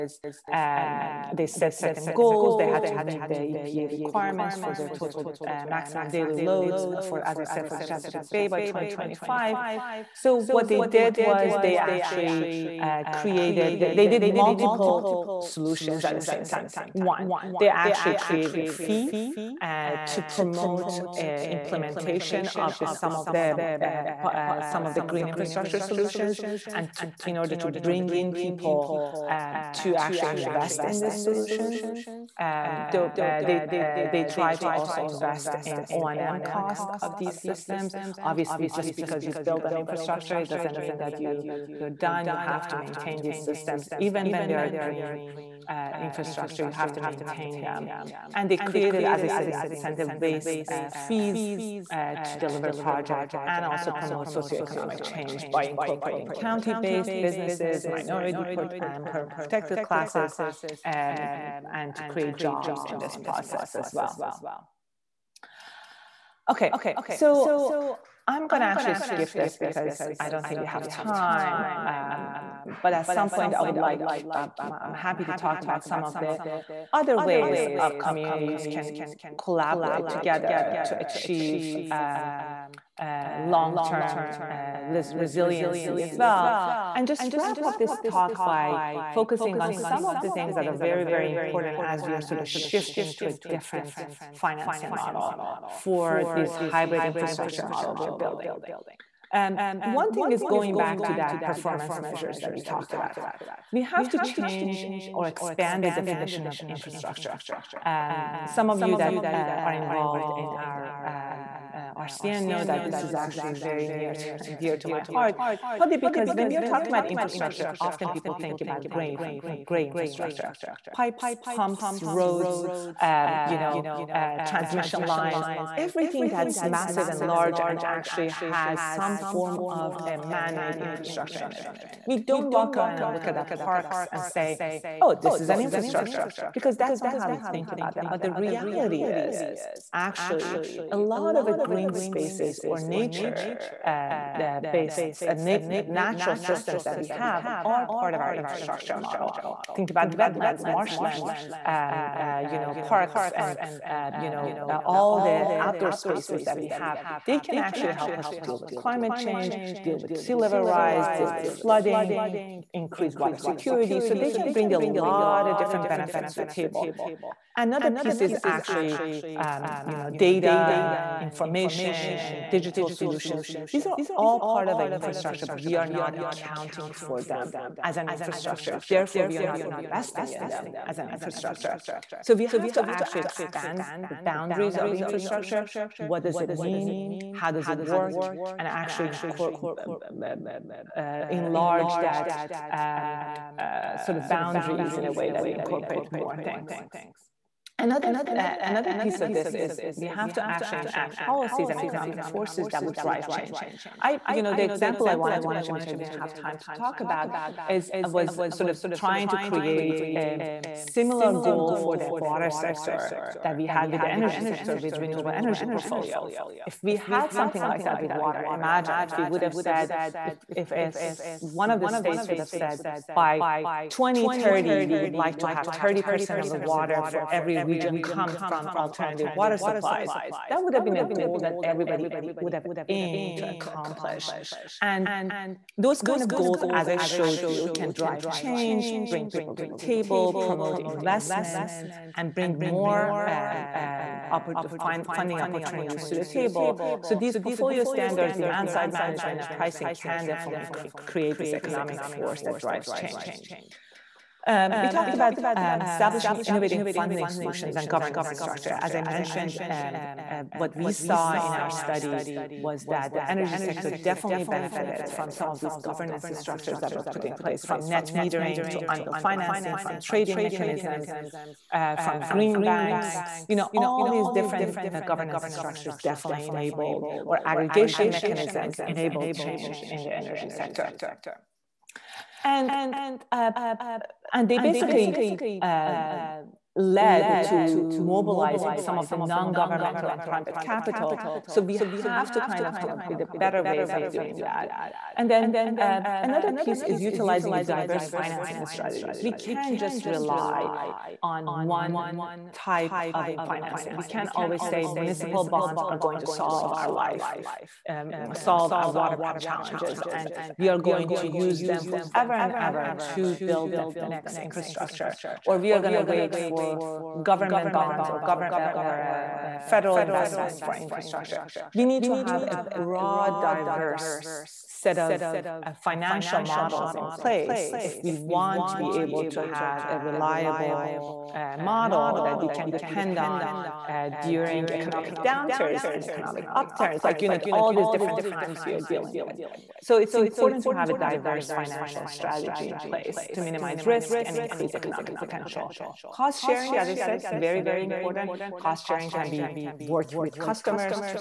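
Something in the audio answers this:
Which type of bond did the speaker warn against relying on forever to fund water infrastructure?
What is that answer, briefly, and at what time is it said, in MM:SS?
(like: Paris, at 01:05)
Municipal bonds, at 05:04.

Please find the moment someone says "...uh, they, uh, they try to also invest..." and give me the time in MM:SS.
00:32.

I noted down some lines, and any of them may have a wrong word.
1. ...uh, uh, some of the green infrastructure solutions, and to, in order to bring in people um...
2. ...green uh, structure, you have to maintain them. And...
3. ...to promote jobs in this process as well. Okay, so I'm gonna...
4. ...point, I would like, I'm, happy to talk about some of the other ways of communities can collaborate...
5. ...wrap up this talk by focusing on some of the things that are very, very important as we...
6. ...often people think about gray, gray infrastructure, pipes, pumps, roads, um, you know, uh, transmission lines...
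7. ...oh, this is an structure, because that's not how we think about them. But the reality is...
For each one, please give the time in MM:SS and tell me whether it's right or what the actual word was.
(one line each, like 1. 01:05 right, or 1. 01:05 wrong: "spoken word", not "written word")
1. 00:23 right
2. 00:44 wrong: "infrastructure", not "structure"
3. 01:01 wrong: "create", not "promote"
4. 01:13 right
5. 01:27 right
6. 01:57 right
7. 02:14 wrong: "infrastructure", not "structure".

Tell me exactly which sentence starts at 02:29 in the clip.
Think about wetlands, marshlands, um, uh, you know, parks, and uh, you know uh, all the outdoor spaces that we have.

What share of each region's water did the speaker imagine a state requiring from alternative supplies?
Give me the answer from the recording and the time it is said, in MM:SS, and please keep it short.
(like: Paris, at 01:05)
30%, at 03:45.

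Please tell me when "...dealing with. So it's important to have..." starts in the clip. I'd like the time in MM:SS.
05:38.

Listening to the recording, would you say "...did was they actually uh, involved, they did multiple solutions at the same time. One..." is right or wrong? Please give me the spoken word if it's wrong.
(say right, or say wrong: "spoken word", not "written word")
wrong: "created", not "involved".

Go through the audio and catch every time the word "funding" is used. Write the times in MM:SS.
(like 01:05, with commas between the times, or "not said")
04:05, 04:16.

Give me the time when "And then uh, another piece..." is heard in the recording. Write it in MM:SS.
04:55.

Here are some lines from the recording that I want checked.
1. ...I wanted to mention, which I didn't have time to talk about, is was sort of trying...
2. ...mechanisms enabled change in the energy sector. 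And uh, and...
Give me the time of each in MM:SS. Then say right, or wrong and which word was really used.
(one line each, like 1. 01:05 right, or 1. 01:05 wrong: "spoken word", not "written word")
1. 03:25 right
2. 04:38 right.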